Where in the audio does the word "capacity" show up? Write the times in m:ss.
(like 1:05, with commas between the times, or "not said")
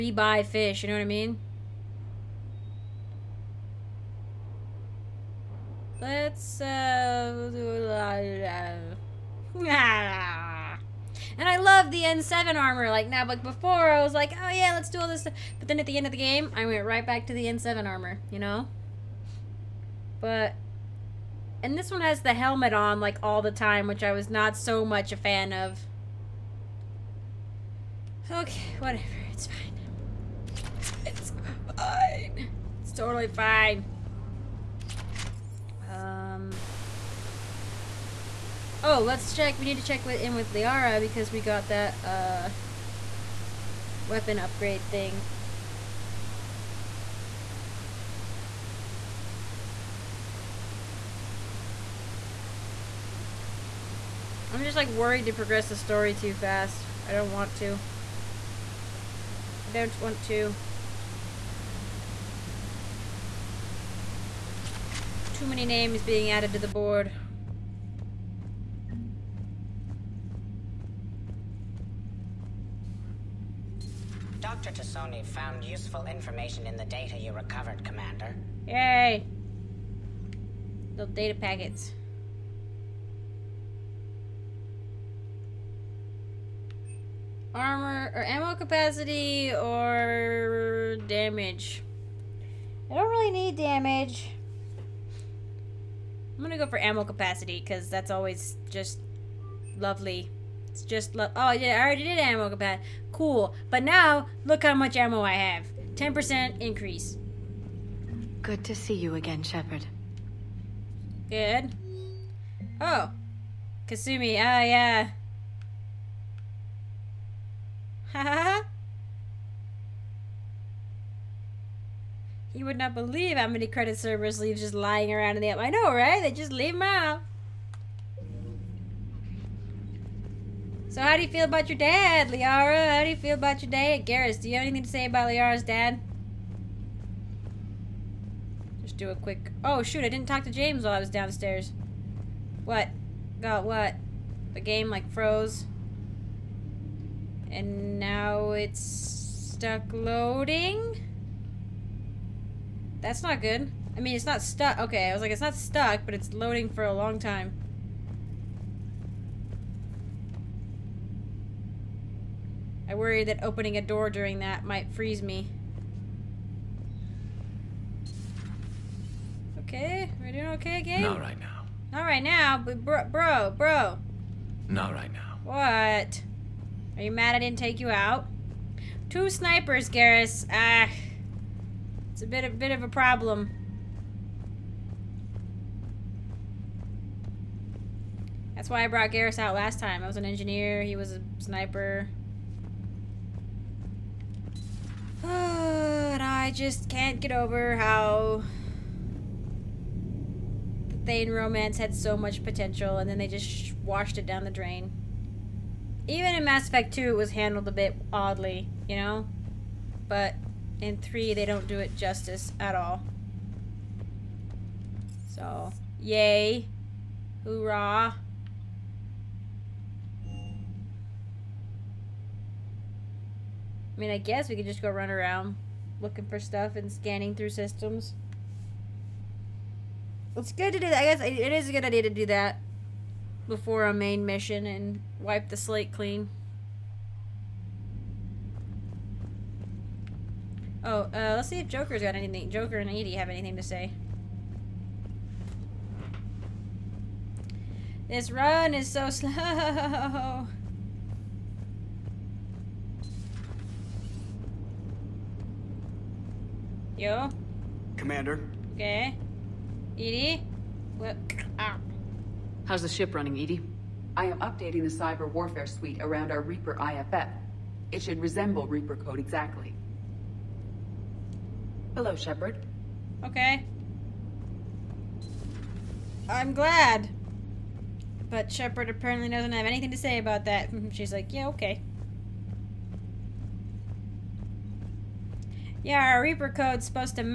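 1:28, 1:37, 1:42.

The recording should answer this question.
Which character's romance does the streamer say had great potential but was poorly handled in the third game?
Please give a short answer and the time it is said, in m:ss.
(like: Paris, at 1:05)
Thane, at 3:21.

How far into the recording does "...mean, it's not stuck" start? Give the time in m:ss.
2:34.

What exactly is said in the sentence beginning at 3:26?
Even in Mass Effect 2, it was handled a bit oddly, you know?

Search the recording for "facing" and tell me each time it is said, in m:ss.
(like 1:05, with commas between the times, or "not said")
not said.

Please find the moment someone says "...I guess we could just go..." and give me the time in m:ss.
3:44.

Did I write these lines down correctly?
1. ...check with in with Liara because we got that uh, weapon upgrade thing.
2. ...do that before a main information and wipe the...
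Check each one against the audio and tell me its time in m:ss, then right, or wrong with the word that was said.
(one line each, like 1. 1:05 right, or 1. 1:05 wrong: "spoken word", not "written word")
1. 0:39 right
2. 3:52 wrong: "mission", not "information".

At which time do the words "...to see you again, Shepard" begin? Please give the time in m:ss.
1:48.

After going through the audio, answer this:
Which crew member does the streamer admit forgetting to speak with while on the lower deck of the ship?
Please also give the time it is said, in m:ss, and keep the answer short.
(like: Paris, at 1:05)
James, at 2:20.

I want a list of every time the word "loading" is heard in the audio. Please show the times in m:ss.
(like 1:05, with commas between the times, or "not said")
2:29, 2:36.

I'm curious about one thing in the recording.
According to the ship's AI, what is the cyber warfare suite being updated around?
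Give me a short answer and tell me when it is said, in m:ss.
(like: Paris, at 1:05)
Reaper IFF, at 4:26.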